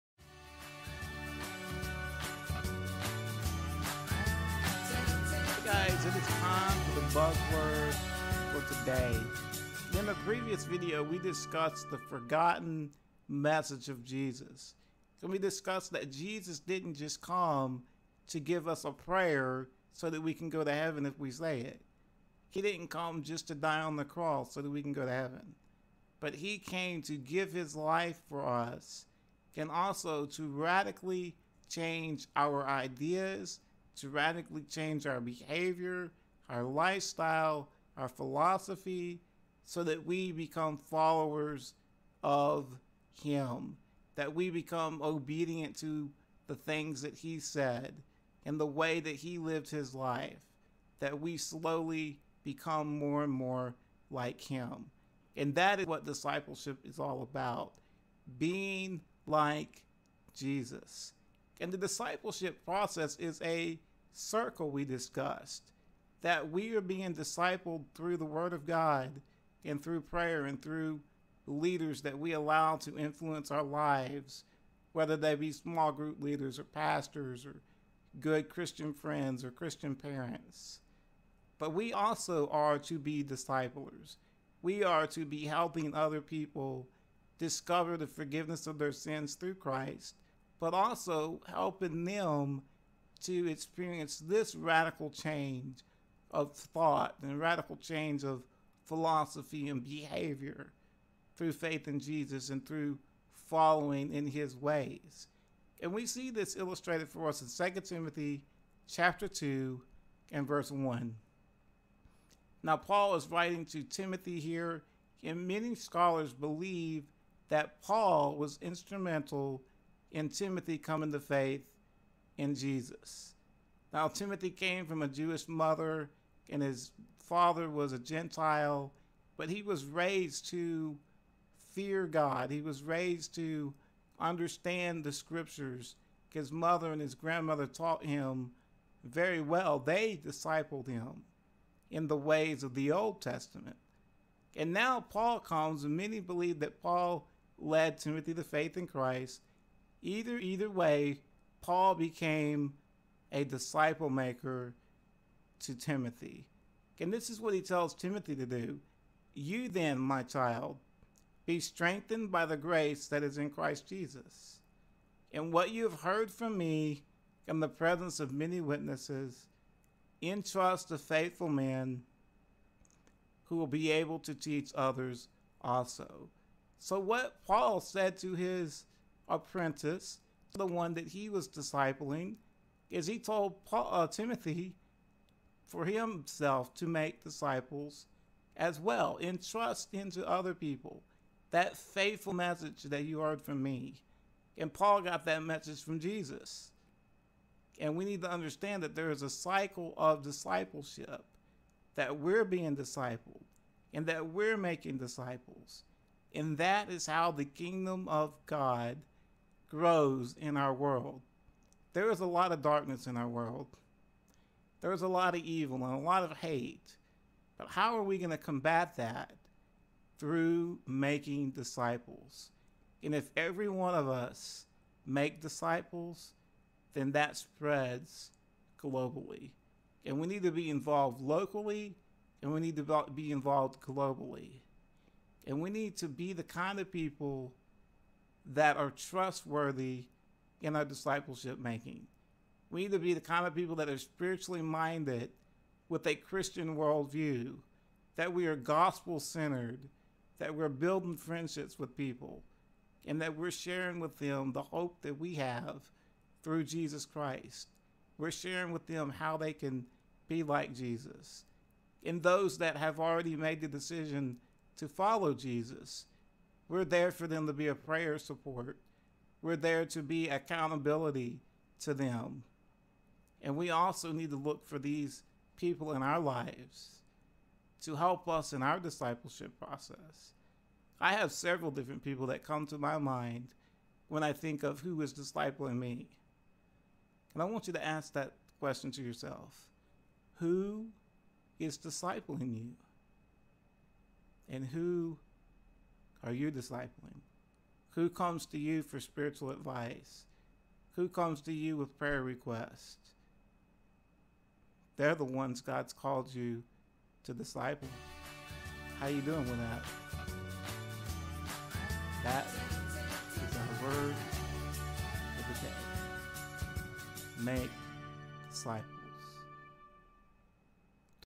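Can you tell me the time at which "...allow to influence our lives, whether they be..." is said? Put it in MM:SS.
01:12.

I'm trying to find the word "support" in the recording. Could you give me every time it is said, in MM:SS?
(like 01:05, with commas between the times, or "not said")
04:28.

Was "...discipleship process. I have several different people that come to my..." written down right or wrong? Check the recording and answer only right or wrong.
right.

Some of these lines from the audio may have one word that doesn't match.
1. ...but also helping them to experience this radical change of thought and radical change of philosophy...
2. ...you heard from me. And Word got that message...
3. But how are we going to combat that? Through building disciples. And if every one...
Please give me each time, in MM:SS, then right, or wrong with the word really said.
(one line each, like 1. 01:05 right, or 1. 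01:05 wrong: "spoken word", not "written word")
1. 01:30 right
2. 03:13 wrong: "Paul", not "Word"
3. 03:37 wrong: "making", not "building".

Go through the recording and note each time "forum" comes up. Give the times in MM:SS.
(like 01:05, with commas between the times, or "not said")
not said.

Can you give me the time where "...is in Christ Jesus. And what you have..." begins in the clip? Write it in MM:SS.
02:43.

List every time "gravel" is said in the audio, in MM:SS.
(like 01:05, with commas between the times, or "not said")
not said.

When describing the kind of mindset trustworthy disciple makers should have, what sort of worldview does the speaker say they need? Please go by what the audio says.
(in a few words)
Christian worldview.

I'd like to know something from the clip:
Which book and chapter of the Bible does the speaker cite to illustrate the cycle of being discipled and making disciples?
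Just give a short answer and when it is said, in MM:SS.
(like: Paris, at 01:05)
2 Timothy chapter 2, at 01:47.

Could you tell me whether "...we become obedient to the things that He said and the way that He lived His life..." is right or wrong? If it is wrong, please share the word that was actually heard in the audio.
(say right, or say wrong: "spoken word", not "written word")
right.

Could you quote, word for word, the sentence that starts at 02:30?
Either either way, Paul became a disciple maker to Timothy.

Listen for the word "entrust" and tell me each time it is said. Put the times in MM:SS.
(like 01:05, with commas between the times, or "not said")
02:50, 03:09.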